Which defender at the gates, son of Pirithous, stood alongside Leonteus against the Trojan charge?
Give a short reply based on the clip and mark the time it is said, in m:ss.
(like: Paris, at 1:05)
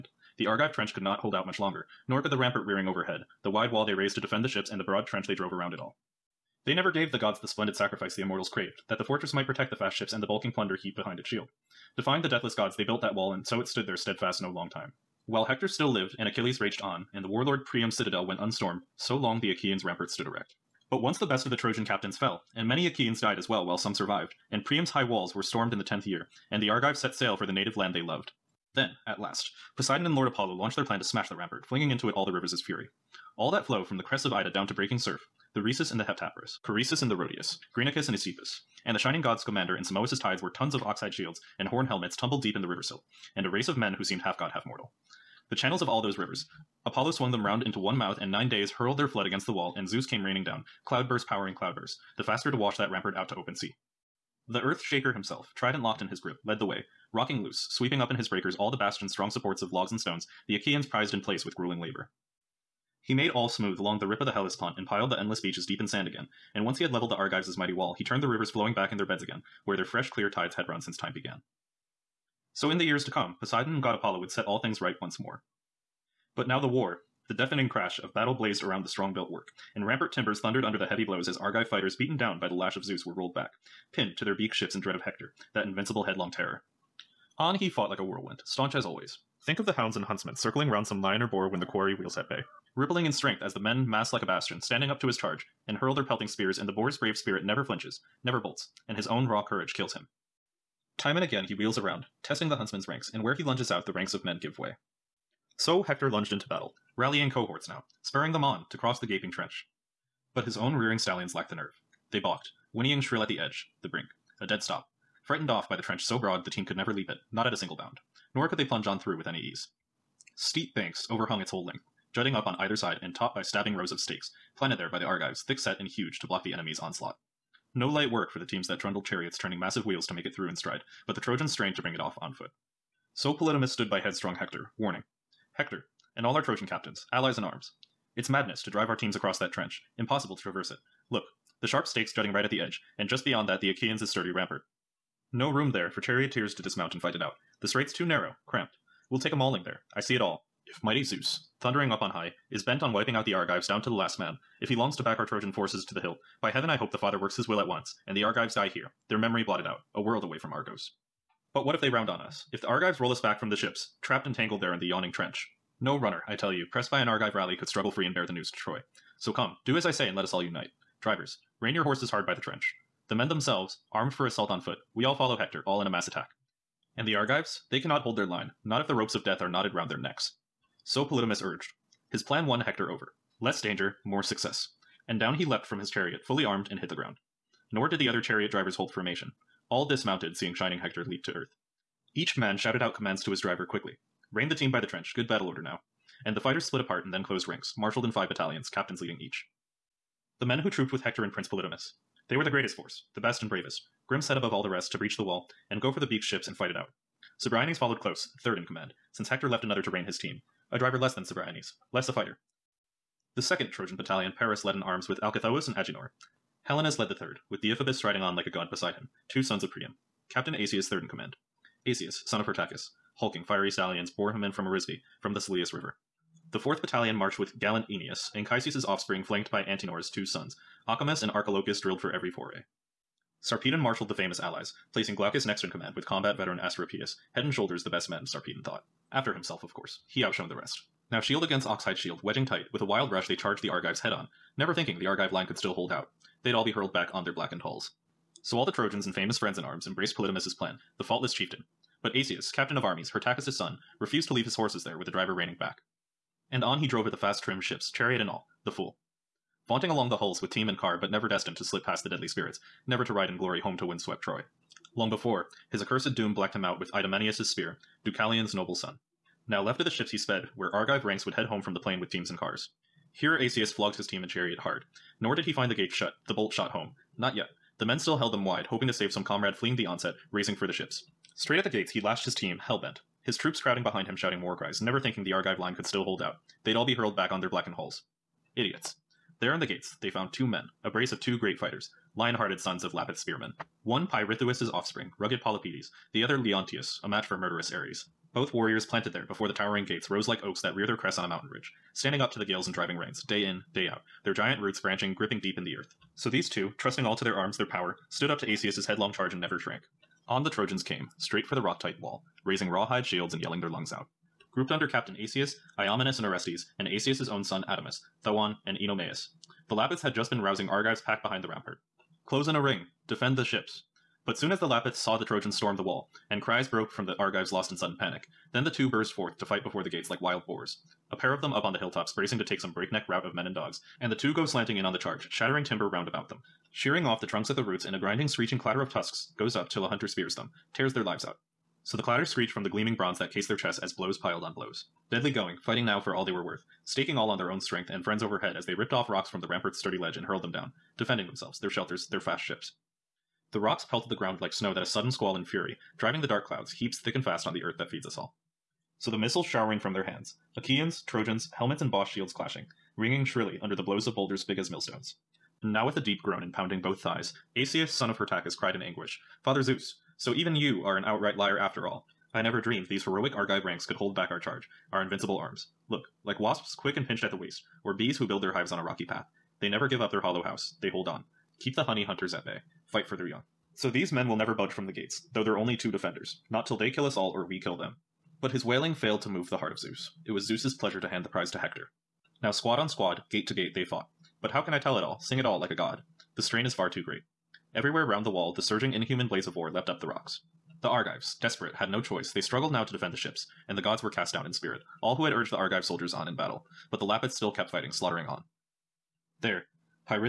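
Polypetes, at 4:55.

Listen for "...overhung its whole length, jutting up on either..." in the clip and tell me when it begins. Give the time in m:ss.
2:01.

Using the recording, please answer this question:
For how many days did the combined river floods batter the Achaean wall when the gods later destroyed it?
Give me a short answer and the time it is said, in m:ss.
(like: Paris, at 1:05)
9, at 0:48.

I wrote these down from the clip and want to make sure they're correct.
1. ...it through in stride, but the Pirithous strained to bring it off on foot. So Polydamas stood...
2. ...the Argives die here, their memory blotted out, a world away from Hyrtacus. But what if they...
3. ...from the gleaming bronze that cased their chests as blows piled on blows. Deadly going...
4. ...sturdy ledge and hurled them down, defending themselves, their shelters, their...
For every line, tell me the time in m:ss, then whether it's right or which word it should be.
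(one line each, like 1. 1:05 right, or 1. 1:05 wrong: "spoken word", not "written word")
1. 2:10 wrong: "Trojans", not "Pirithous"
2. 2:38 wrong: "Argos", not "Hyrtacus"
3. 5:42 right
4. 5:49 right.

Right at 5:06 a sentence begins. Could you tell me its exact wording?
So these two, trusting all to their arms, their power, stood up to Asius' headlong charge and never shrank.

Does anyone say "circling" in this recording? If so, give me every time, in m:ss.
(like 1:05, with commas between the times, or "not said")
1:30.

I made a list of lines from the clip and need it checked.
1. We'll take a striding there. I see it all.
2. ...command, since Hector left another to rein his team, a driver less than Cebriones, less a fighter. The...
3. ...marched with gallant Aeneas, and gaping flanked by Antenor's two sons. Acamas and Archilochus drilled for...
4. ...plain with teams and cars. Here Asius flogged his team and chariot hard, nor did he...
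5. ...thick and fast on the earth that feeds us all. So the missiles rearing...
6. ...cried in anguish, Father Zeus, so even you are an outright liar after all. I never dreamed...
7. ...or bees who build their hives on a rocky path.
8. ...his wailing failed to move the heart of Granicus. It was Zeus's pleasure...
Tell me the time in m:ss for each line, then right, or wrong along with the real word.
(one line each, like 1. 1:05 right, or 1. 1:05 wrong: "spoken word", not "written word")
1. 2:29 wrong: "mauling", not "striding"
2. 3:28 right
3. 3:47 wrong: "offspring", not "gaping"
4. 4:31 right
5. 5:56 wrong: "showering", not "rearing"
6. 6:08 right
7. 6:17 right
8. 6:28 wrong: "Zeus", not "Granicus".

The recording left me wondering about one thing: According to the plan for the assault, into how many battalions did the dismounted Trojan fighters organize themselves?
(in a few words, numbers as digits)
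5.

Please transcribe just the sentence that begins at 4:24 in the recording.
Long before, his accursed doom blacked him out with Idomeneus' spear, Deucalion's noble son.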